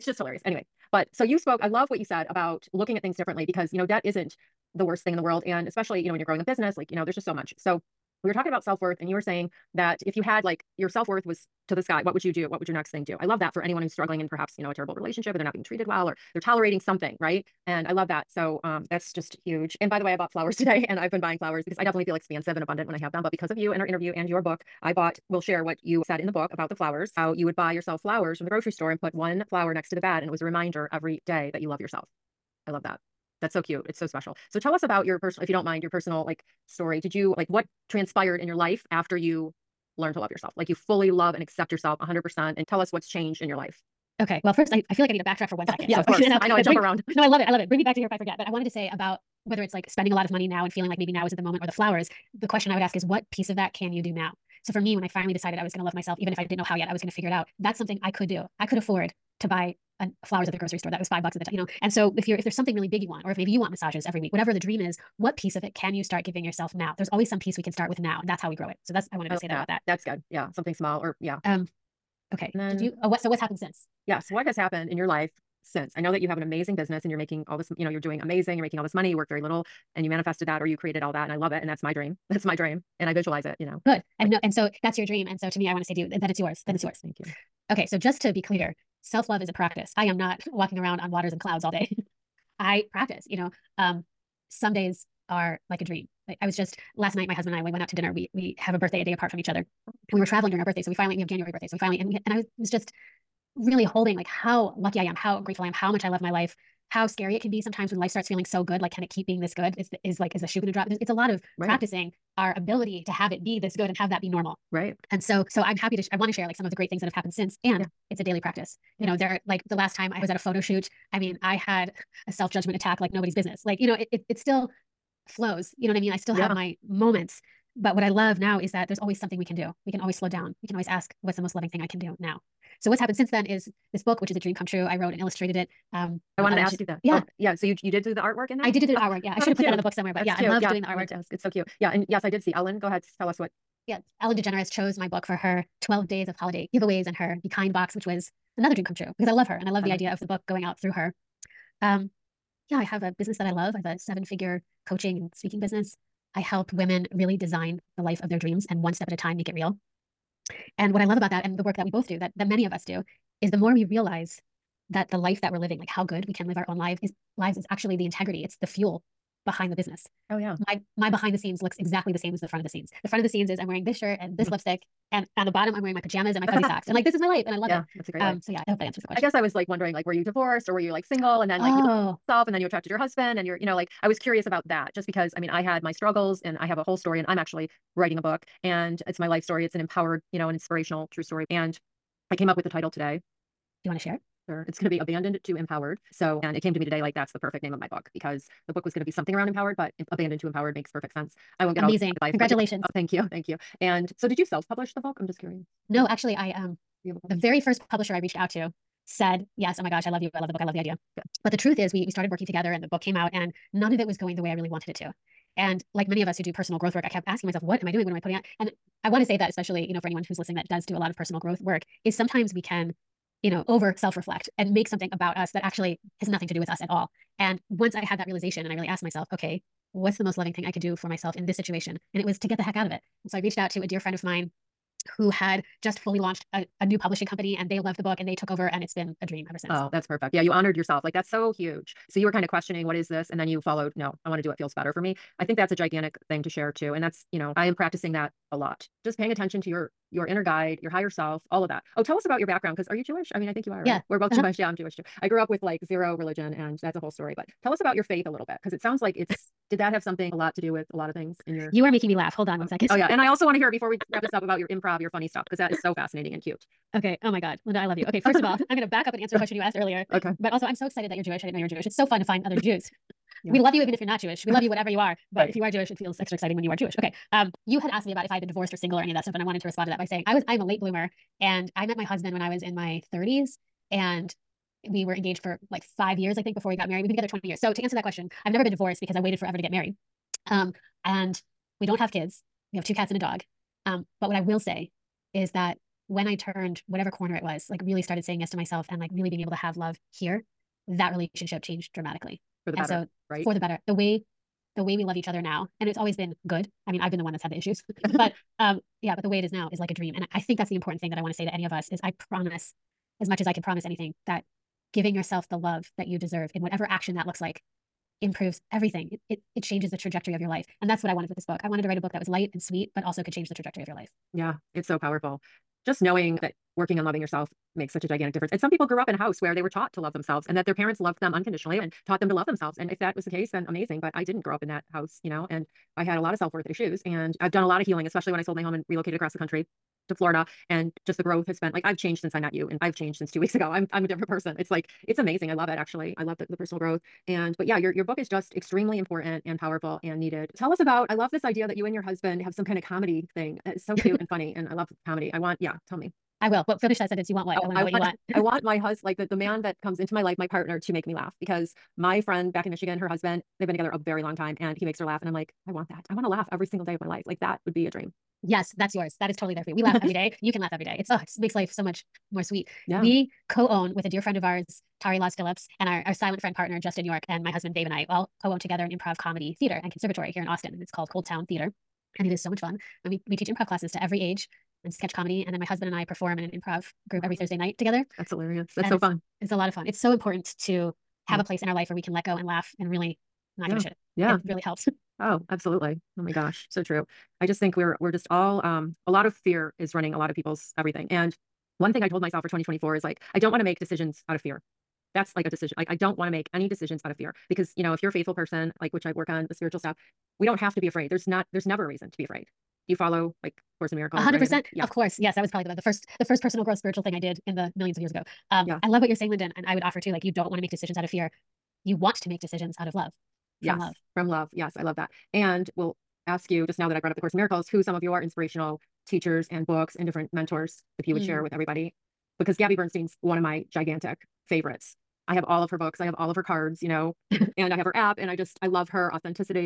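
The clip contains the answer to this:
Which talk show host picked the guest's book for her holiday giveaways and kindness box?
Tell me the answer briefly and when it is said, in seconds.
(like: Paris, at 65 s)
Ellen DeGeneres, at 144 s.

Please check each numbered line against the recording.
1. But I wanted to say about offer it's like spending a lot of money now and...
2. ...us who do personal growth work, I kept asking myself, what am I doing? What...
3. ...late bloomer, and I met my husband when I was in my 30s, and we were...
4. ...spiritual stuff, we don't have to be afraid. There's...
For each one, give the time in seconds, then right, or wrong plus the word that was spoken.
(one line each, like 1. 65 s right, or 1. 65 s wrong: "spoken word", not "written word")
1. 48 s wrong: "whether", not "offer"
2. 216 s right
3. 280 s right
4. 409 s right.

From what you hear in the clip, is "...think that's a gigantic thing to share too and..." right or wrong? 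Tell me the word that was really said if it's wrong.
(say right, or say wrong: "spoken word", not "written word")
right.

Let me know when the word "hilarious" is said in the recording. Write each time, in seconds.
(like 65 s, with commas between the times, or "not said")
0 s, 388 s.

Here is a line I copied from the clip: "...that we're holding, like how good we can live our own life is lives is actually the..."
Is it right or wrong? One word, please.
wrong.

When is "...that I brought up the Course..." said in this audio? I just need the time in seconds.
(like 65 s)
426 s.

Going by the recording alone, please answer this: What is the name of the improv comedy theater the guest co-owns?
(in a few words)
ColdTowne Theater.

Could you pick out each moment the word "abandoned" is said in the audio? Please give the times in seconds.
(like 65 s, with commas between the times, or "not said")
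194 s, 200 s.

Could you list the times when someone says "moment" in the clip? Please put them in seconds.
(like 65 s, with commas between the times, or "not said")
51 s, 126 s.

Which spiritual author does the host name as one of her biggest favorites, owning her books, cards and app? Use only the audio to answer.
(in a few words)
Gabby Bernstein.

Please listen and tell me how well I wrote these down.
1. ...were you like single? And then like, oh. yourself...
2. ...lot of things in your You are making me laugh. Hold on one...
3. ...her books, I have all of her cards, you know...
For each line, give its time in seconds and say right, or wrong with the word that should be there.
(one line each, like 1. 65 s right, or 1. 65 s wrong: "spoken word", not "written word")
1. 180 s right
2. 260 s right
3. 435 s right.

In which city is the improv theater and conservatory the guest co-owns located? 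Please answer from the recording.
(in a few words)
Austin.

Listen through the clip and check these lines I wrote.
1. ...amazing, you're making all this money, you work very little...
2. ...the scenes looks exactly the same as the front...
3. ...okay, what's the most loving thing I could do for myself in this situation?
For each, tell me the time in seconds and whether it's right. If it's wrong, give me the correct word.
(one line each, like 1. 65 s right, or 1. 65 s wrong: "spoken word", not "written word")
1. 78 s right
2. 171 s right
3. 229 s right.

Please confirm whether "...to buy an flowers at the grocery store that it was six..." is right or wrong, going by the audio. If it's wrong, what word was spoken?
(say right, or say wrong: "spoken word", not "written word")
wrong: "five", not "six".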